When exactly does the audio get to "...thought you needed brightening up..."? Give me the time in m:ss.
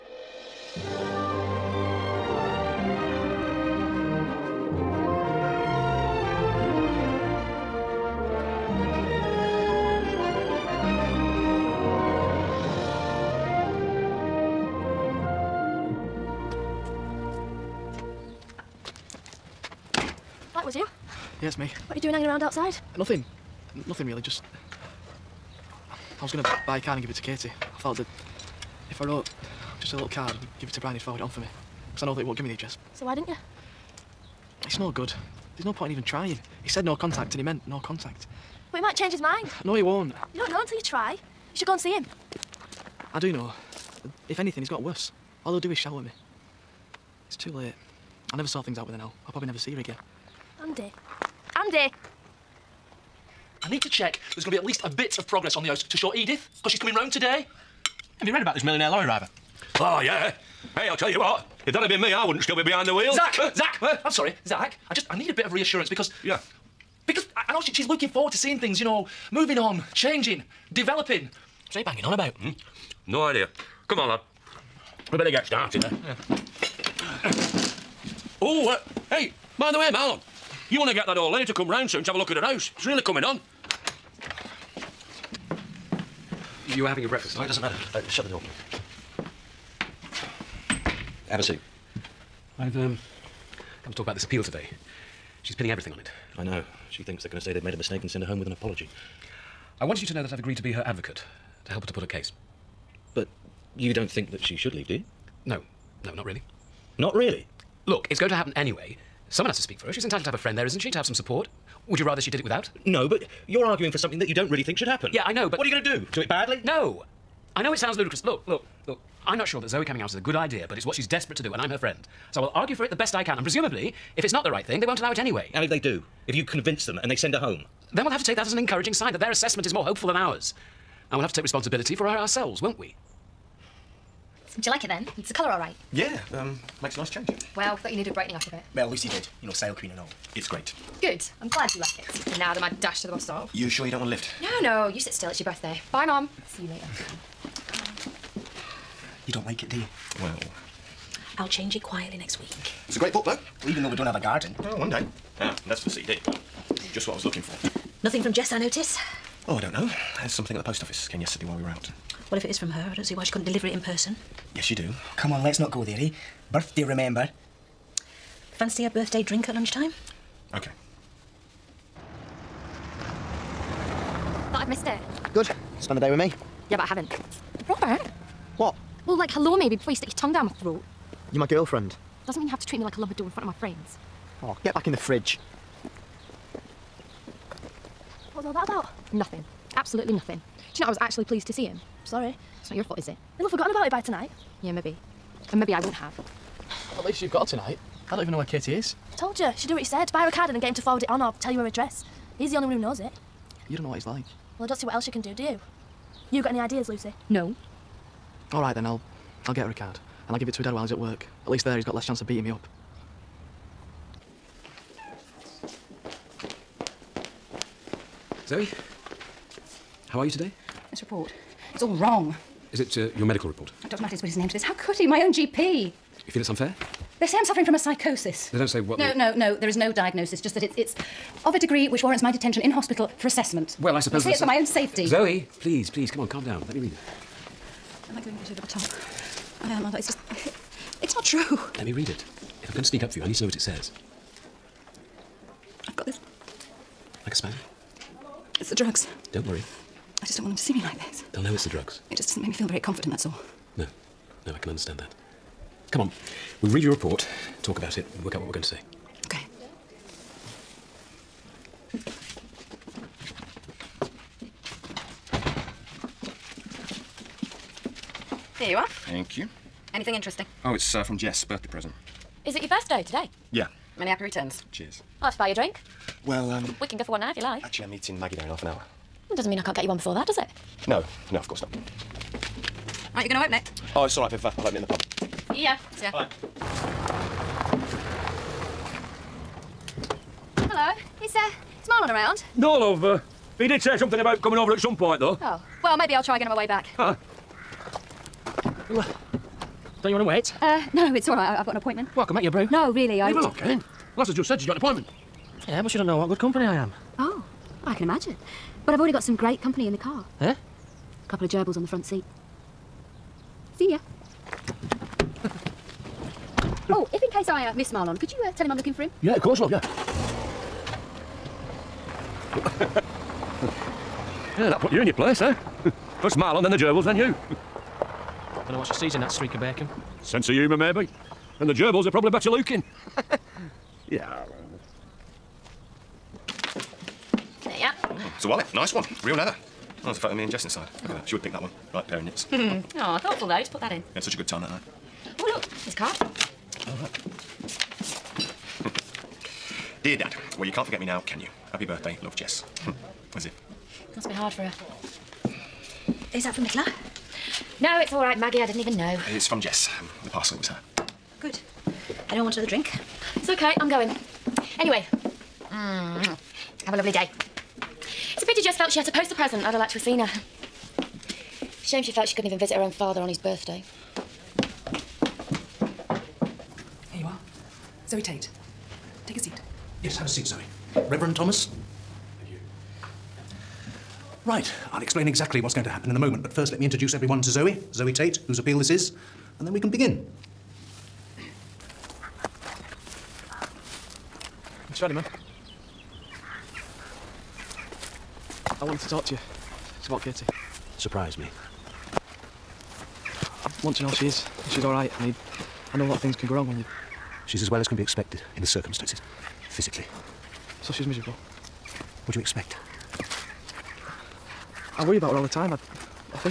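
2:17.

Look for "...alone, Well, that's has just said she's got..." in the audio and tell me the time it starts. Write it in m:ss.
5:03.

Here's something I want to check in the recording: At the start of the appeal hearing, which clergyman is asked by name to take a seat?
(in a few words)
Reverend Thomas.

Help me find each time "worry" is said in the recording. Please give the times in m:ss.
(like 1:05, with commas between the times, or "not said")
4:09, 6:55.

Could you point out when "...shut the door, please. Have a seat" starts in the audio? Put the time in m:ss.
1:28.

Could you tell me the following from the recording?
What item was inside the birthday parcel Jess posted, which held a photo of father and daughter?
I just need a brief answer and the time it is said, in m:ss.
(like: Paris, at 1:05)
Wallet, at 5:38.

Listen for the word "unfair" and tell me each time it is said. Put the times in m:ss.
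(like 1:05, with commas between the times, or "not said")
3:46.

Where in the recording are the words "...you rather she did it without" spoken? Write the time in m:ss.
1:51.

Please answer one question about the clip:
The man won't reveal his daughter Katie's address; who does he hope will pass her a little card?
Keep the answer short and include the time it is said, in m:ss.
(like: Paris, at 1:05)
Brian, at 0:30.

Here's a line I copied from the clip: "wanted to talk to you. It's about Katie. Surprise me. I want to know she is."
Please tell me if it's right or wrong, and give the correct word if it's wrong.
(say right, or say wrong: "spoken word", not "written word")
right.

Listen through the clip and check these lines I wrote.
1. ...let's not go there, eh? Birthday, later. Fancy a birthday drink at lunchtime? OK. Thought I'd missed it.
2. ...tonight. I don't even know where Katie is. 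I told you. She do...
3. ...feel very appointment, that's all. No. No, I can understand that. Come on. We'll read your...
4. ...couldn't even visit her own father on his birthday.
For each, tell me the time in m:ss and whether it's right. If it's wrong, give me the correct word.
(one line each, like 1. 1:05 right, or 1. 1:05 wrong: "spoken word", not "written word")
1. 2:45 wrong: "remember", not "later"
2. 3:17 right
3. 4:12 wrong: "confident", not "appointment"
4. 6:12 right.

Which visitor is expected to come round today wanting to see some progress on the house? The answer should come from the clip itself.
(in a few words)
Edith.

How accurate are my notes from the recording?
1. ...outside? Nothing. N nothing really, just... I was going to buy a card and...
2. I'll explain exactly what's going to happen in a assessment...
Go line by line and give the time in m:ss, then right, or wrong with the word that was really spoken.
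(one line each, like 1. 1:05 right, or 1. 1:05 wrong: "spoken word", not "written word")
1. 0:22 right
2. 6:24 wrong: "moment", not "assessment".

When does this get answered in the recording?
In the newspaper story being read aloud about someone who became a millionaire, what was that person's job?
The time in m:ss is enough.
0:58.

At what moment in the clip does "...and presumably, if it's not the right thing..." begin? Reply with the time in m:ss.
2:03.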